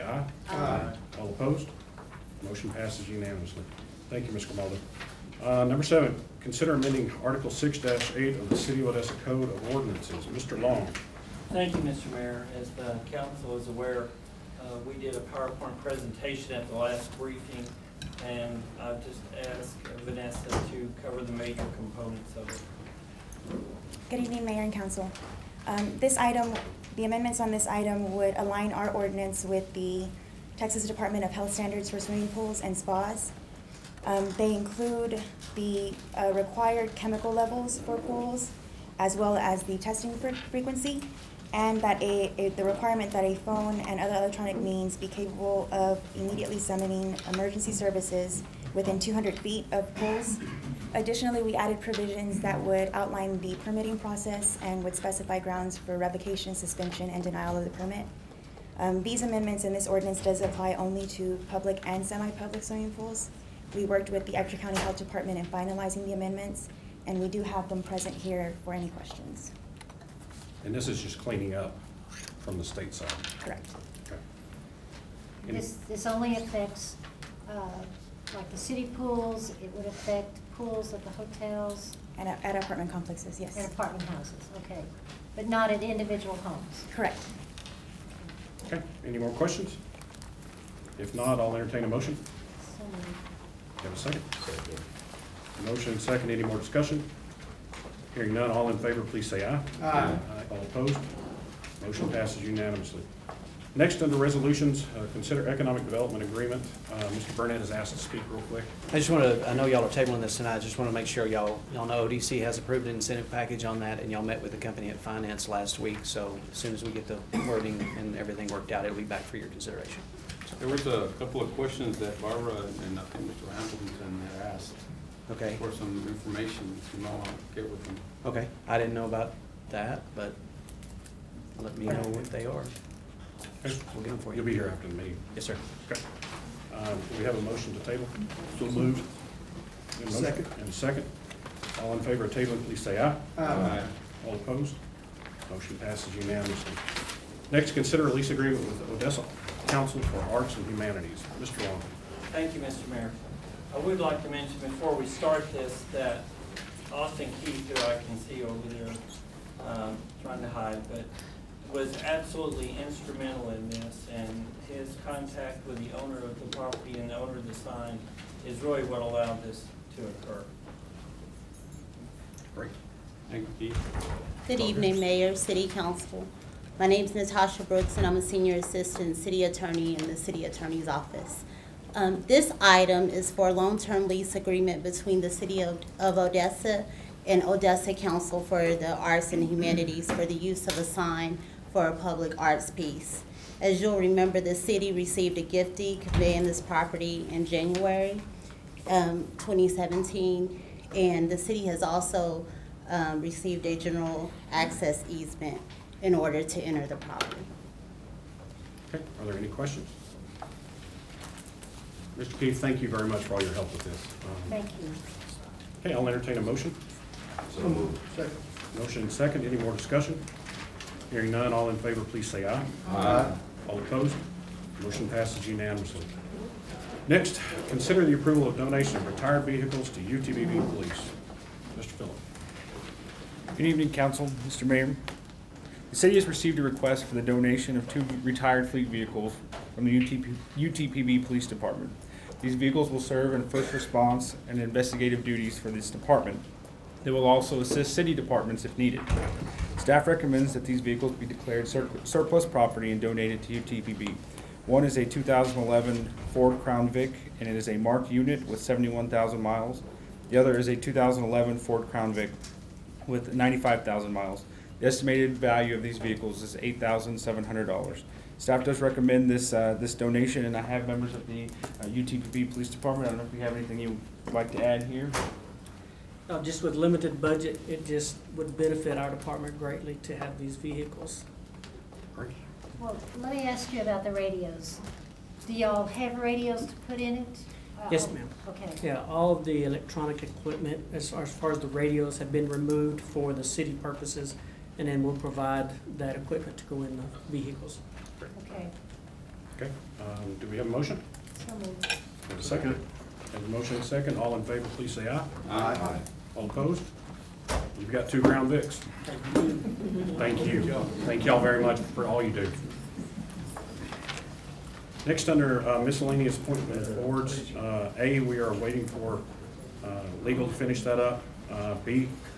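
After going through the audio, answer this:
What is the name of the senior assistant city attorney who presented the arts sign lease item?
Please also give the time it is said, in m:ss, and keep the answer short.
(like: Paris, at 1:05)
Natasha Brooks, at 2:57.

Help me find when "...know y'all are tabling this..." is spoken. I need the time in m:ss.
1:49.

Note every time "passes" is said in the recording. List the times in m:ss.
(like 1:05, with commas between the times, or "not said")
0:02, 1:42, 2:25, 3:45.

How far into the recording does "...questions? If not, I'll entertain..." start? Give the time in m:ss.
1:29.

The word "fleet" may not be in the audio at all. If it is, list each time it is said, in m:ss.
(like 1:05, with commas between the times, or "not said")
3:58.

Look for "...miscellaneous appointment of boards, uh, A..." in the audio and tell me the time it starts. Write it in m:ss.
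5:15.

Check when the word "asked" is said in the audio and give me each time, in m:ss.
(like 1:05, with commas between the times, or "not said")
0:19, 1:47, 2:04.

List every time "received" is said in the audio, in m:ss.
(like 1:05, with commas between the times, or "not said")
3:14, 3:23, 3:56.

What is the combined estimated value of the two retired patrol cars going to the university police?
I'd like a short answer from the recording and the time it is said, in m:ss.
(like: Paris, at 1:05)
$8,700, at 4:26.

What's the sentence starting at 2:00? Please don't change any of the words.
There was a couple of questions that Barbara and I think Mr.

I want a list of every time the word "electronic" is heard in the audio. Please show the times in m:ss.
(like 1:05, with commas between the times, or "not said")
0:44, 4:49.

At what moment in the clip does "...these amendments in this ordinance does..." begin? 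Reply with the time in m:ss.
0:59.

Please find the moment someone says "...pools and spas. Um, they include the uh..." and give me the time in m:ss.
0:32.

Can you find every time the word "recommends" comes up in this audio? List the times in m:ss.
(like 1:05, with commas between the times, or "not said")
4:10, 4:28.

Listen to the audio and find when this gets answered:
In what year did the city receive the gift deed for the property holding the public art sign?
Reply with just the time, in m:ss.
3:19.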